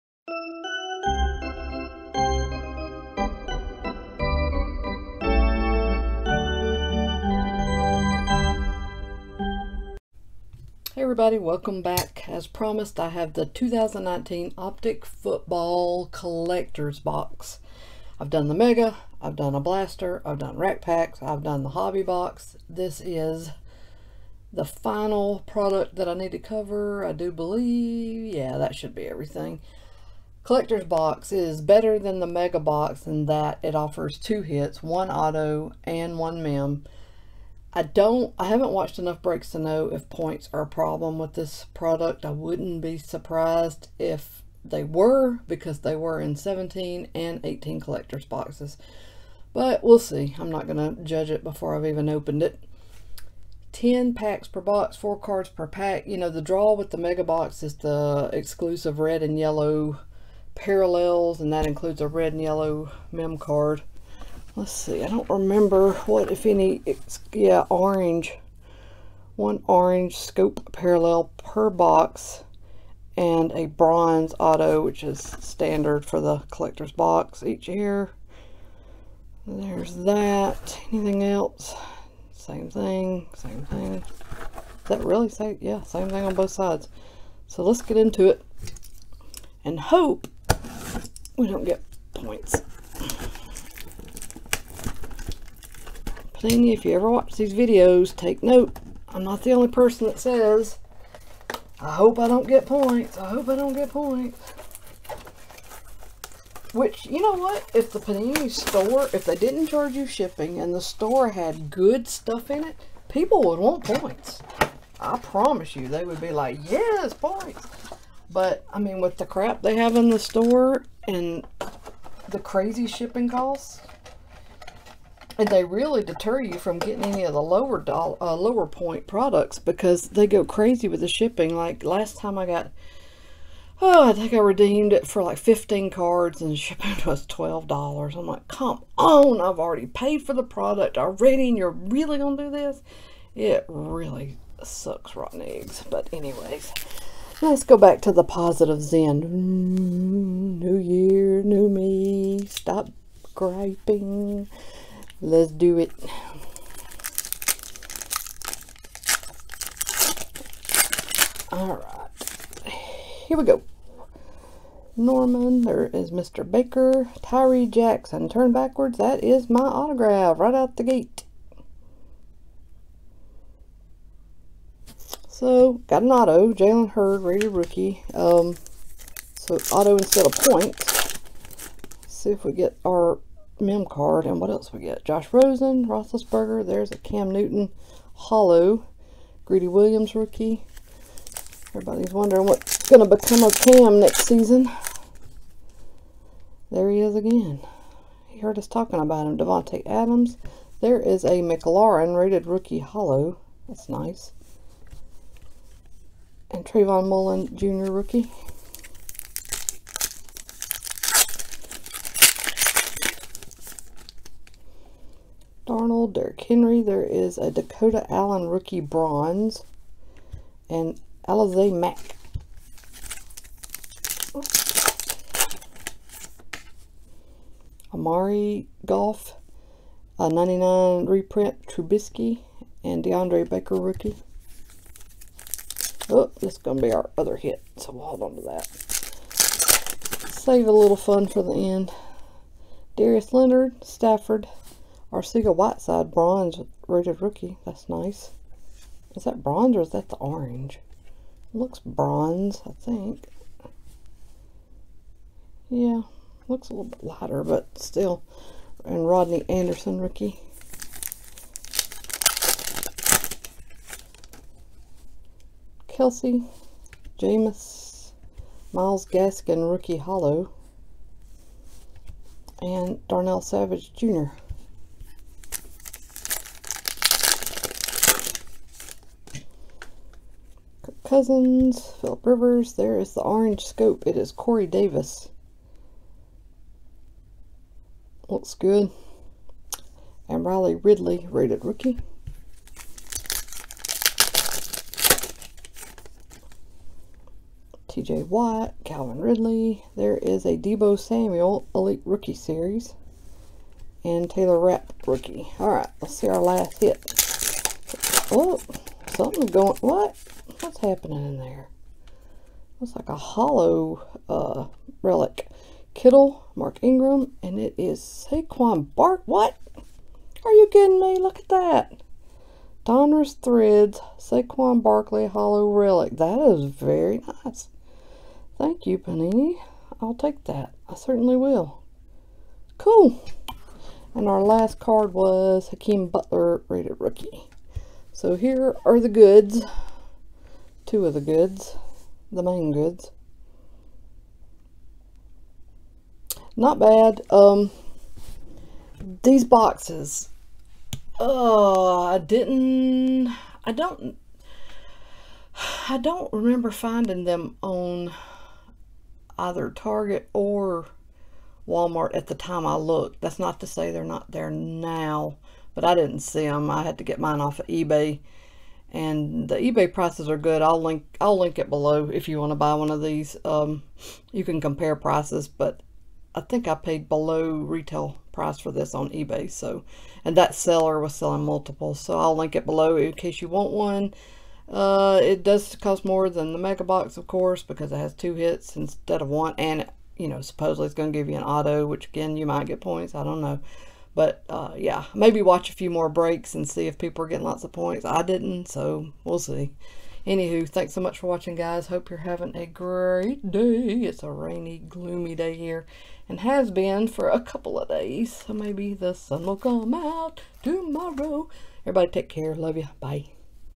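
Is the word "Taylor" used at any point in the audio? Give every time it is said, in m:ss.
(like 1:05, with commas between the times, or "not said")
5:04.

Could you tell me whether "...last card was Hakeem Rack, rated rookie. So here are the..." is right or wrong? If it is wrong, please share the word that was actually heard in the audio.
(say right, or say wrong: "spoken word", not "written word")
wrong: "Butler", not "Rack".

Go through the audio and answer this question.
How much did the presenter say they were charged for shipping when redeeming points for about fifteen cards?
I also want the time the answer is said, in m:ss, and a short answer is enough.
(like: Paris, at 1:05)
$12, at 2:17.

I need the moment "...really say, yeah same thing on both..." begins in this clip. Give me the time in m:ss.
1:25.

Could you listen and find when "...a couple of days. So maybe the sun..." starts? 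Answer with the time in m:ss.
6:47.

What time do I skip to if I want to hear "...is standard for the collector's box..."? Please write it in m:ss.
1:15.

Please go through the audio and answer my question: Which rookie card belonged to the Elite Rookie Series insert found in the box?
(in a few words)
Deebo Samuel.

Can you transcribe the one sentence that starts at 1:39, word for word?
I'm not the only person that says, I hope I don't get points.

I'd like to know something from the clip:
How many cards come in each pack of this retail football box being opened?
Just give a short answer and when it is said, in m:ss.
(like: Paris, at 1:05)
4, at 0:54.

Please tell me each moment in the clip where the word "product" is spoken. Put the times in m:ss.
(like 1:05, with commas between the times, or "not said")
0:25, 0:41, 2:09, 2:20.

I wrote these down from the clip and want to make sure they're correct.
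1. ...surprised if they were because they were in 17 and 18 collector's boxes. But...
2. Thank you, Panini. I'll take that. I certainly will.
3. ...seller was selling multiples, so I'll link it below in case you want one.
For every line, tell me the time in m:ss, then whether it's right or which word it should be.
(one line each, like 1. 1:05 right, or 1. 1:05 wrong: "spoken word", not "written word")
1. 0:42 right
2. 5:28 right
3. 6:20 right.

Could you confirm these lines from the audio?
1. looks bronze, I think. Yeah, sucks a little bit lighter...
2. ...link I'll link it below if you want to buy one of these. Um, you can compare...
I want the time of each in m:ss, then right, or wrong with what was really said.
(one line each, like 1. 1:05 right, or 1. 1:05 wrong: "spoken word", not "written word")
1. 4:11 wrong: "looks", not "sucks"
2. 6:10 right.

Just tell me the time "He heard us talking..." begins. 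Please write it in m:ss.
3:18.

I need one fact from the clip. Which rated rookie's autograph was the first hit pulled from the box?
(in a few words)
Jalen Hurd.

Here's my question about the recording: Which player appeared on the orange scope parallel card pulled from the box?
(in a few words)
Corey Davis.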